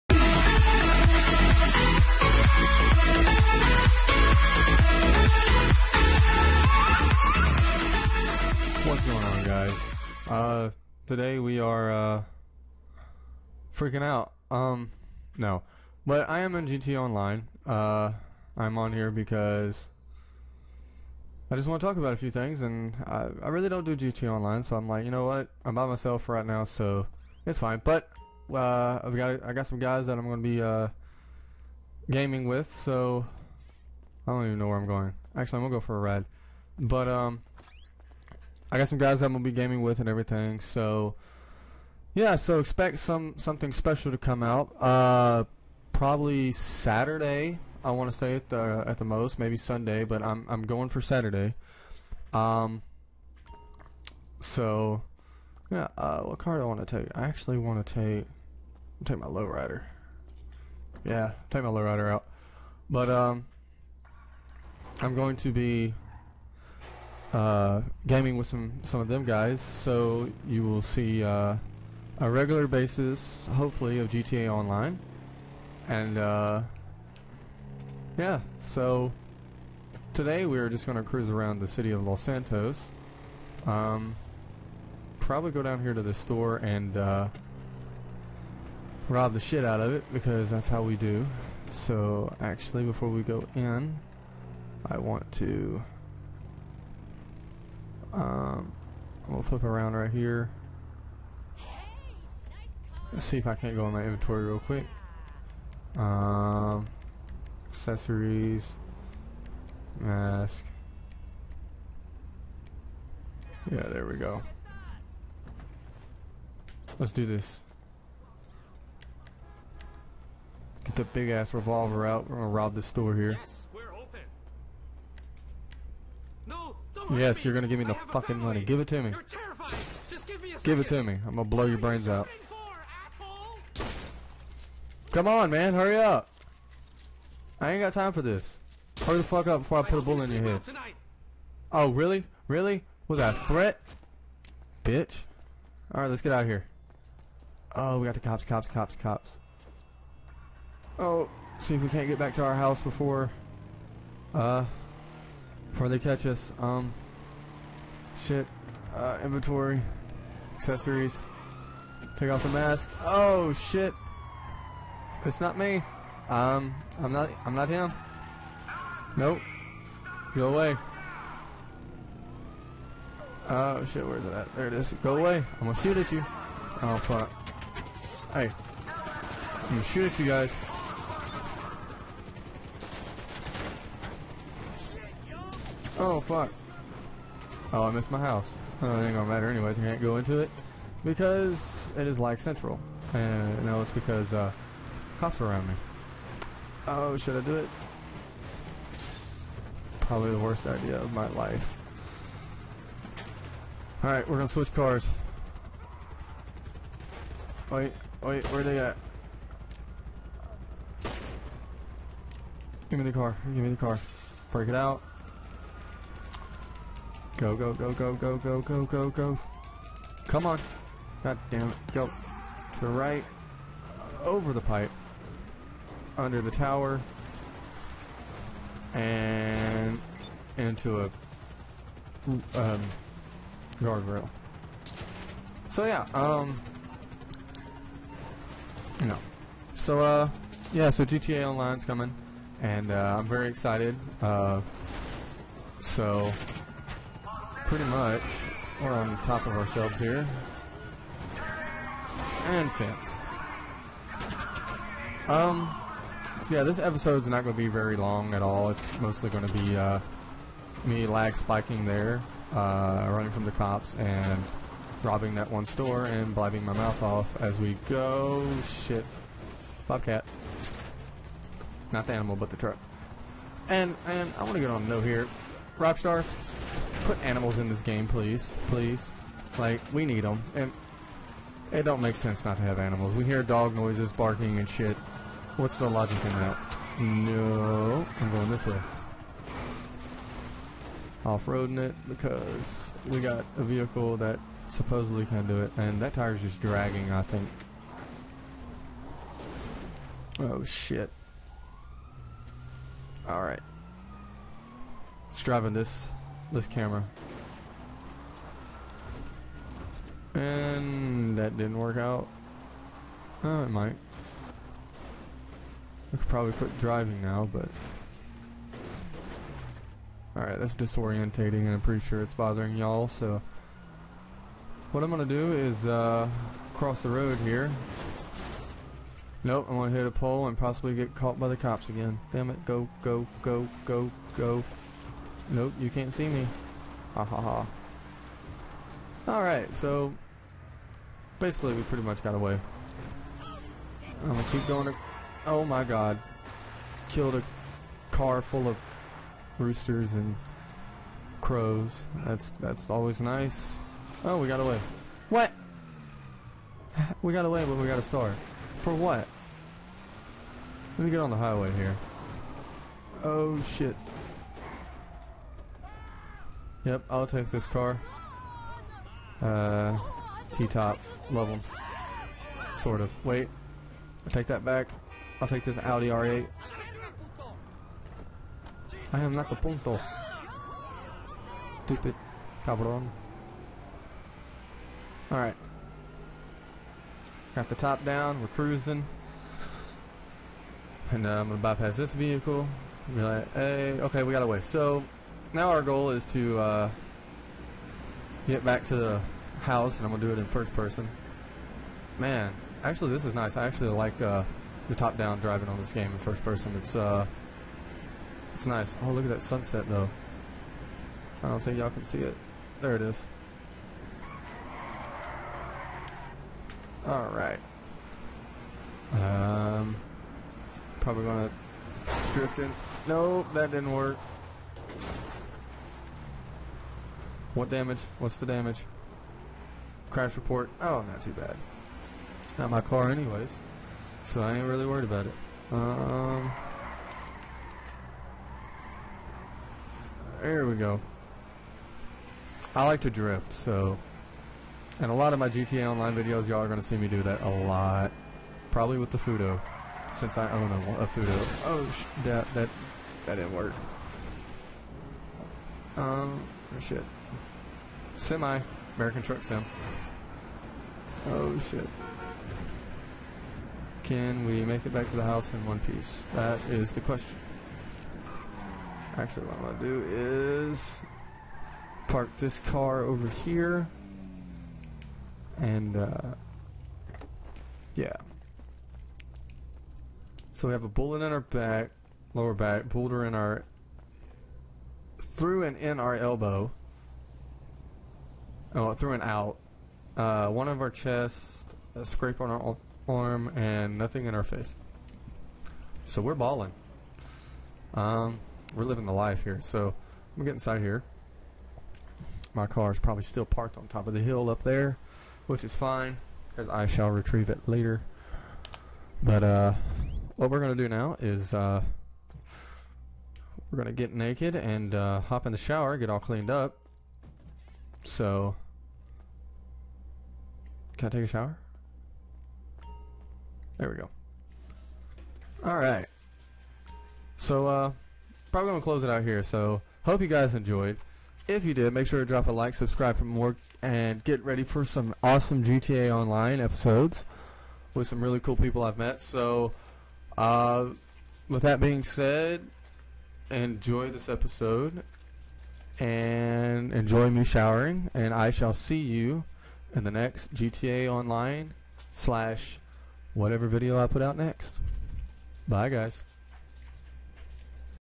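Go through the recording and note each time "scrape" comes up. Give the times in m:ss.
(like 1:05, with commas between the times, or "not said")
8:12.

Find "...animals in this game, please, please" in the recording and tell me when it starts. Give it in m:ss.
4:37.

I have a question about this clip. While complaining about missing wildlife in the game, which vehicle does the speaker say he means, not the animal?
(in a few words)
Bobcat.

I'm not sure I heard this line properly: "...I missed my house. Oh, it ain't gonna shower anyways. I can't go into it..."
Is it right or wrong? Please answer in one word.
wrong.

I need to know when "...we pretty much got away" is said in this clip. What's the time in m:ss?
5:41.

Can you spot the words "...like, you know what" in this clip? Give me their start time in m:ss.
0:24.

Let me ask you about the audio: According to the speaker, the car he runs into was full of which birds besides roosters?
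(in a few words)
Crows.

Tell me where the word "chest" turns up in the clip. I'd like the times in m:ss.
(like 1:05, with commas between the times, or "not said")
8:10.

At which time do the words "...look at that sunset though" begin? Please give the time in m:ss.
6:49.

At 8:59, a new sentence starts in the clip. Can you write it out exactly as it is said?
So, uh, with that being said, enjoy this episode and enjoy me showering.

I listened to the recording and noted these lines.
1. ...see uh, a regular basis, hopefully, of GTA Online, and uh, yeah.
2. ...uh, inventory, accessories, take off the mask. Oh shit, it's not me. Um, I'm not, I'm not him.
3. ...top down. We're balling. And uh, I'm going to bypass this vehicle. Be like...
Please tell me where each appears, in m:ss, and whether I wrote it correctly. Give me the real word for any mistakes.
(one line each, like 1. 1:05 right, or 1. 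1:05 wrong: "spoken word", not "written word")
1. 1:10 right
2. 2:38 right
3. 6:27 wrong: "cruising", not "balling".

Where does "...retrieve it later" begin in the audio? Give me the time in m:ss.
8:27.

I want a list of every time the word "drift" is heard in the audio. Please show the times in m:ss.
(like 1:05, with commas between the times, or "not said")
7:02, 7:23.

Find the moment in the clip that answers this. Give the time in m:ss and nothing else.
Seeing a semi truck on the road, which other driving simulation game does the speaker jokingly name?
7:38.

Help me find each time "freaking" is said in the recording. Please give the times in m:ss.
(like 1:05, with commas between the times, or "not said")
0:13.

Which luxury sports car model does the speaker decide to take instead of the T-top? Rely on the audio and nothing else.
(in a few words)
Audi R8.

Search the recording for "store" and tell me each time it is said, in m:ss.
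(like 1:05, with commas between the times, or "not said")
1:26, 2:02, 4:25.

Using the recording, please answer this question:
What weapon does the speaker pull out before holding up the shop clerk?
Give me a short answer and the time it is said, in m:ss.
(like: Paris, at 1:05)
Revolver, at 2:01.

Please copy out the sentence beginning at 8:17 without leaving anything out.
Um, we're living the life here.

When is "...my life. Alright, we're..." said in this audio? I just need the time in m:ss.
3:21.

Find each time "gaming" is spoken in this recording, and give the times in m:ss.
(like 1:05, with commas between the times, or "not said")
0:32, 0:39, 1:08.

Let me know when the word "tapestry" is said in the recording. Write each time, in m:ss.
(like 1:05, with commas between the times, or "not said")
not said.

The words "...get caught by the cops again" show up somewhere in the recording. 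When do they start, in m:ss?
5:30.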